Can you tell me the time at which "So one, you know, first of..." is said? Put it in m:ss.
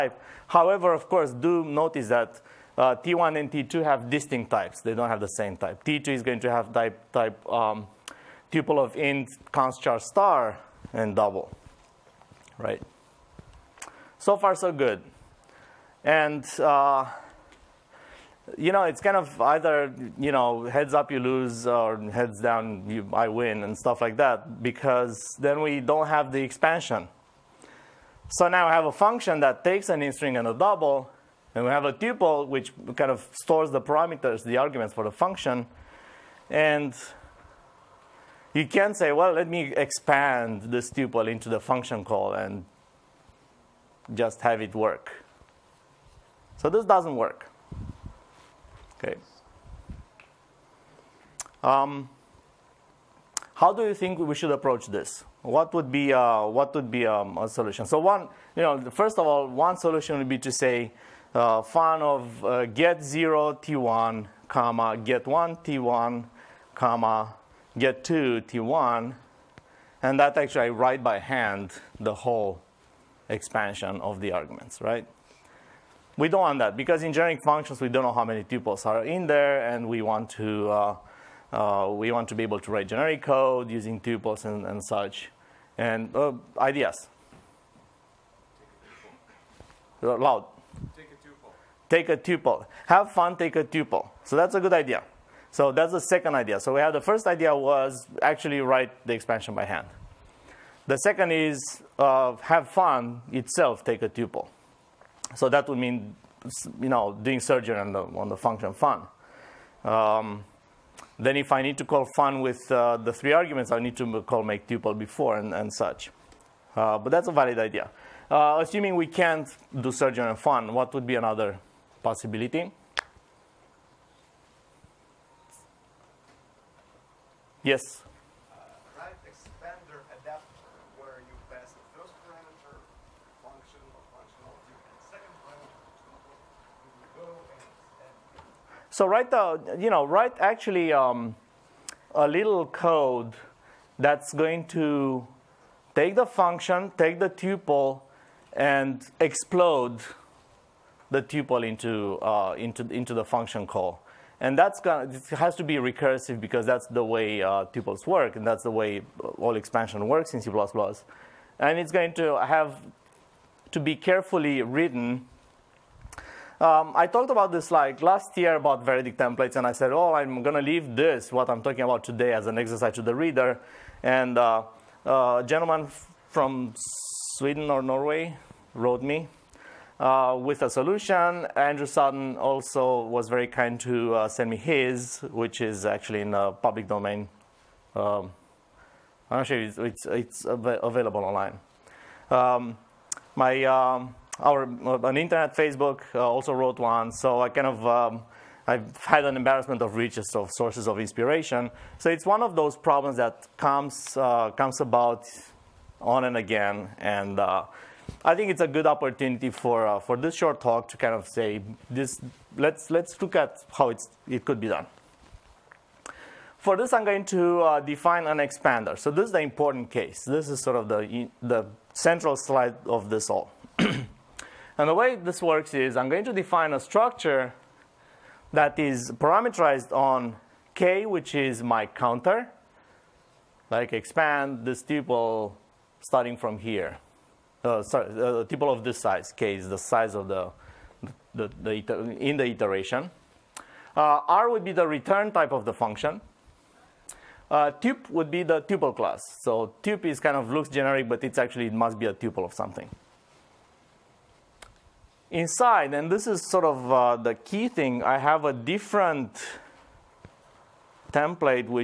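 0:57.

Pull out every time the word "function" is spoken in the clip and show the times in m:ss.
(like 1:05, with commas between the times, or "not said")
0:28, 0:35, 0:41, 1:17, 1:48, 2:26, 2:33, 4:05.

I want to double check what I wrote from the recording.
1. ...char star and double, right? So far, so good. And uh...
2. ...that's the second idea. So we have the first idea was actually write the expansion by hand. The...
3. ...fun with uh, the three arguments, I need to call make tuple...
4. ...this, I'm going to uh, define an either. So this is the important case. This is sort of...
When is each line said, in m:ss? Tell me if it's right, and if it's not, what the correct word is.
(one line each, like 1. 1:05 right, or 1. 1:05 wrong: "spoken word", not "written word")
1. 0:09 right
2. 1:35 right
3. 1:52 right
4. 3:36 wrong: "expander", not "either".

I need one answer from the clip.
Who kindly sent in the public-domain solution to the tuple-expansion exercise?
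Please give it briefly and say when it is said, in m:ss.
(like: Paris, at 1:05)
Andrew Sutton, at 3:01.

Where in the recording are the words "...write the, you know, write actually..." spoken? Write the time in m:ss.
2:19.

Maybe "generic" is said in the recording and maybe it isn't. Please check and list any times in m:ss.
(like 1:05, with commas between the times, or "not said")
1:17, 1:22, 4:10.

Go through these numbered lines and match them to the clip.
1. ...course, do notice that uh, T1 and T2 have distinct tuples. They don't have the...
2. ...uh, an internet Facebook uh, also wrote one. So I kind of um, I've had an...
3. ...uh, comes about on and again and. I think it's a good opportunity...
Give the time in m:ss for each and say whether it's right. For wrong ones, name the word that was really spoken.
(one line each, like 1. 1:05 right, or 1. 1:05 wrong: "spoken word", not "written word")
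1. 0:01 wrong: "types", not "tuples"
2. 3:14 right
3. 3:24 right.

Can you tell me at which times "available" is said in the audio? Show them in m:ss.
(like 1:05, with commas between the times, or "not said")
3:10.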